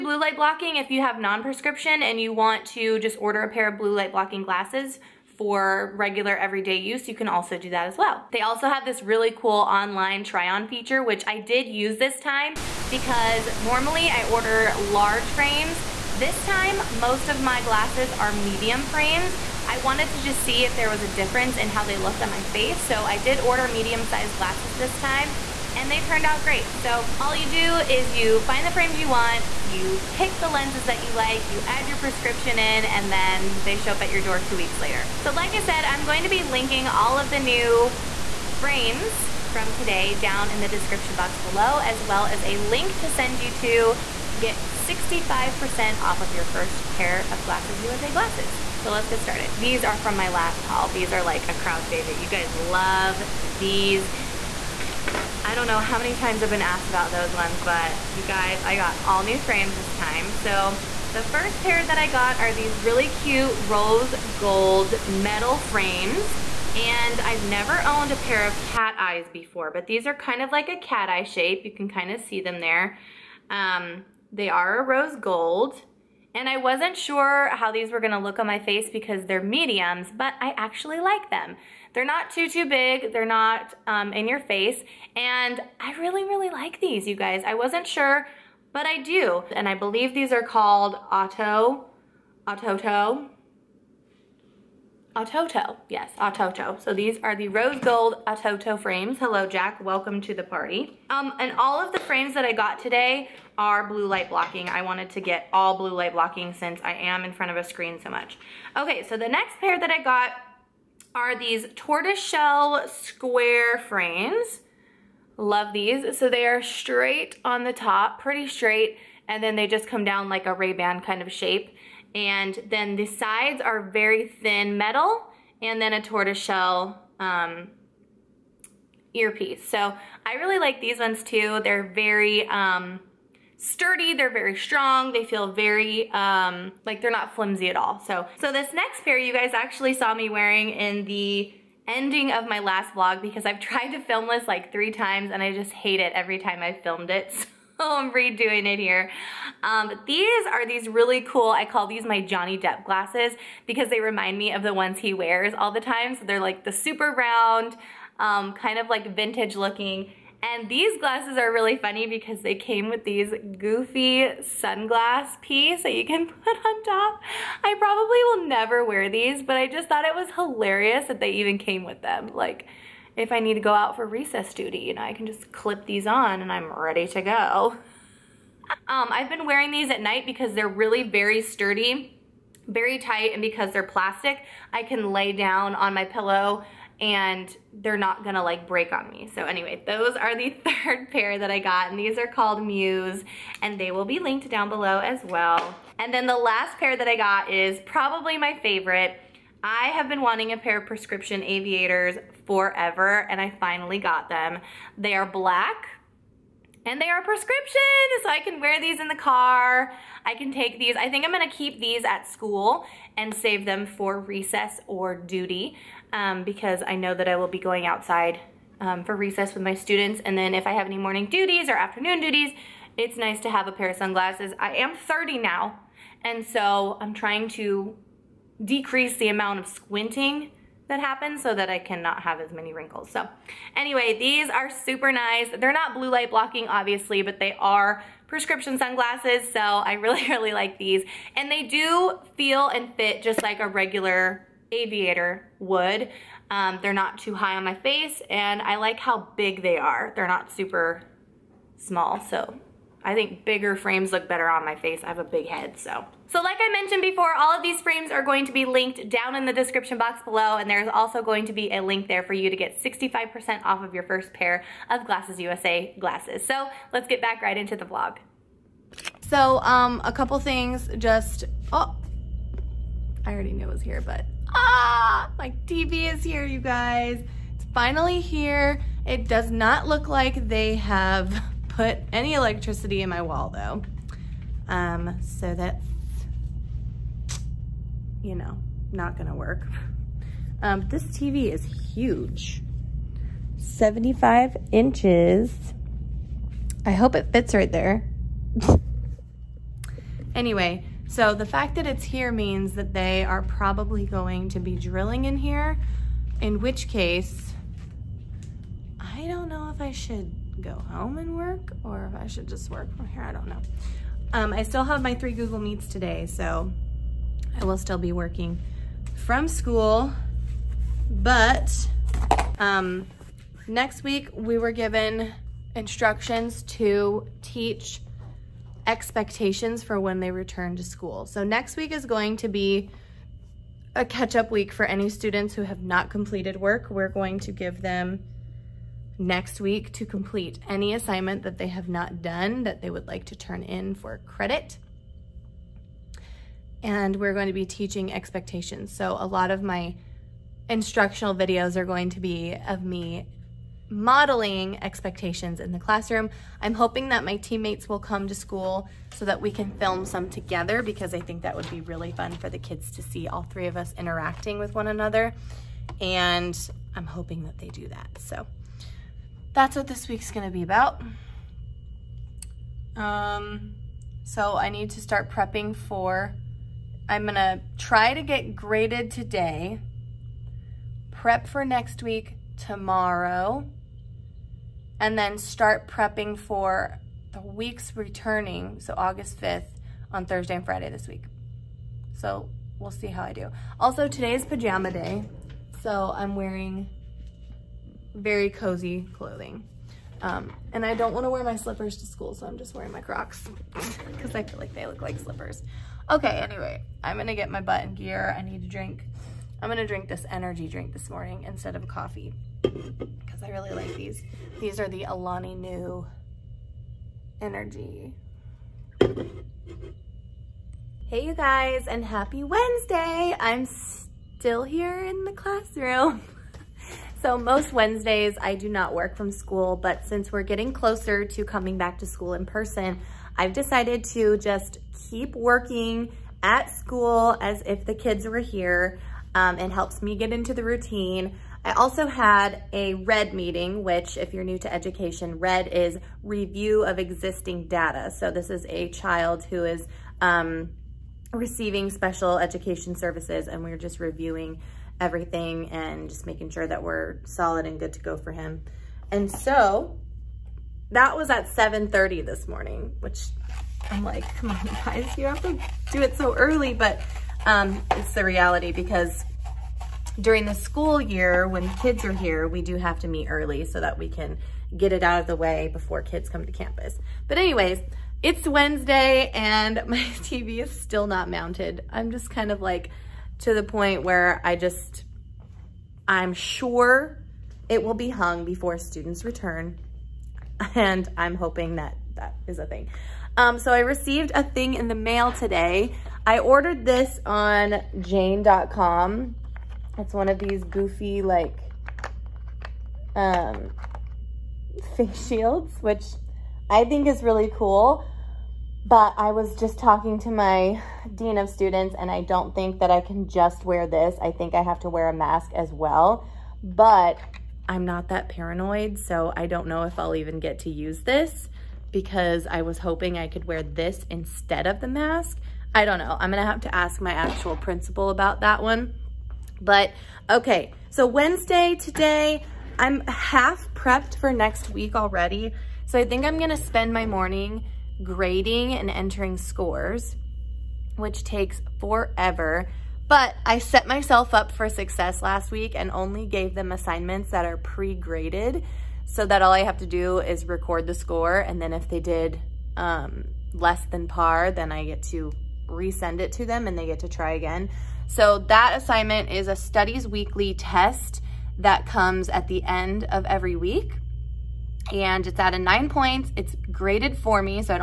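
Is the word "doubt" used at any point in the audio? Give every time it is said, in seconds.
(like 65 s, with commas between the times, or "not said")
not said.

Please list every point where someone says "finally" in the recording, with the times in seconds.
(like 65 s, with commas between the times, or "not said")
203 s, 277 s.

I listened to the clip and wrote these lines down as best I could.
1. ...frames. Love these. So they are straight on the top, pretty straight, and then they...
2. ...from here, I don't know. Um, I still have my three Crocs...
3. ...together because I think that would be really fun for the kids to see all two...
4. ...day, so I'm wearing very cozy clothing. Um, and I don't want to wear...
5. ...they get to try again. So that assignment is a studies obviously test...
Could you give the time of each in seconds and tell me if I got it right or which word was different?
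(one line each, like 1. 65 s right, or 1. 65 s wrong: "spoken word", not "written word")
1. 113 s right
2. 312 s wrong: "Google", not "Crocs"
3. 360 s wrong: "three", not "two"
4. 394 s right
5. 556 s wrong: "weekly", not "obviously".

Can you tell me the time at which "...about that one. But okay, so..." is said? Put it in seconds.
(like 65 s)
528 s.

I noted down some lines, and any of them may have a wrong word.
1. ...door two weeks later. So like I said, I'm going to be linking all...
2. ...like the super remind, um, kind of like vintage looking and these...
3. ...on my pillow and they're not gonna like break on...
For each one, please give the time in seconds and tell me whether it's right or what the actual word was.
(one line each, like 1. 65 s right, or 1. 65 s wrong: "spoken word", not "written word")
1. 34 s right
2. 156 s wrong: "round", not "remind"
3. 185 s right.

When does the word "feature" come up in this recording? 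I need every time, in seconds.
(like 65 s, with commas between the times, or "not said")
10 s.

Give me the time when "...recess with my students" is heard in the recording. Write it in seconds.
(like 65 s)
219 s.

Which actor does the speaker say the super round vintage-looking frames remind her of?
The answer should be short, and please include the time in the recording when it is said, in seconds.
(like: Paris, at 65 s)
Johnny Depp, at 152 s.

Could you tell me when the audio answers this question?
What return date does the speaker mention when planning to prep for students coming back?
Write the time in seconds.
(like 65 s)
388 s.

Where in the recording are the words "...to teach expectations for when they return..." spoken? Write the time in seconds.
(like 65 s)
326 s.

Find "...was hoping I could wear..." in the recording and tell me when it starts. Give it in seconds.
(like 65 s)
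522 s.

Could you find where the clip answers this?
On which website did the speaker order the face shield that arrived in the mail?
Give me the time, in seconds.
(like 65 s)
497 s.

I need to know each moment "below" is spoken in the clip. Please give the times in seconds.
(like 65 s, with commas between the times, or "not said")
41 s, 194 s, 260 s.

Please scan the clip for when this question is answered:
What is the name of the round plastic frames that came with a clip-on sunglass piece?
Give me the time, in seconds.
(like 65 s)
192 s.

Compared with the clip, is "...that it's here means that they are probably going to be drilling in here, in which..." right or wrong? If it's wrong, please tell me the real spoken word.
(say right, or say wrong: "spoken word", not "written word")
right.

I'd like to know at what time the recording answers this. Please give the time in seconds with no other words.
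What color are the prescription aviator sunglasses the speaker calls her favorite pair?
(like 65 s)
205 s.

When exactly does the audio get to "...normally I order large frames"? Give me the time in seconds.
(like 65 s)
13 s.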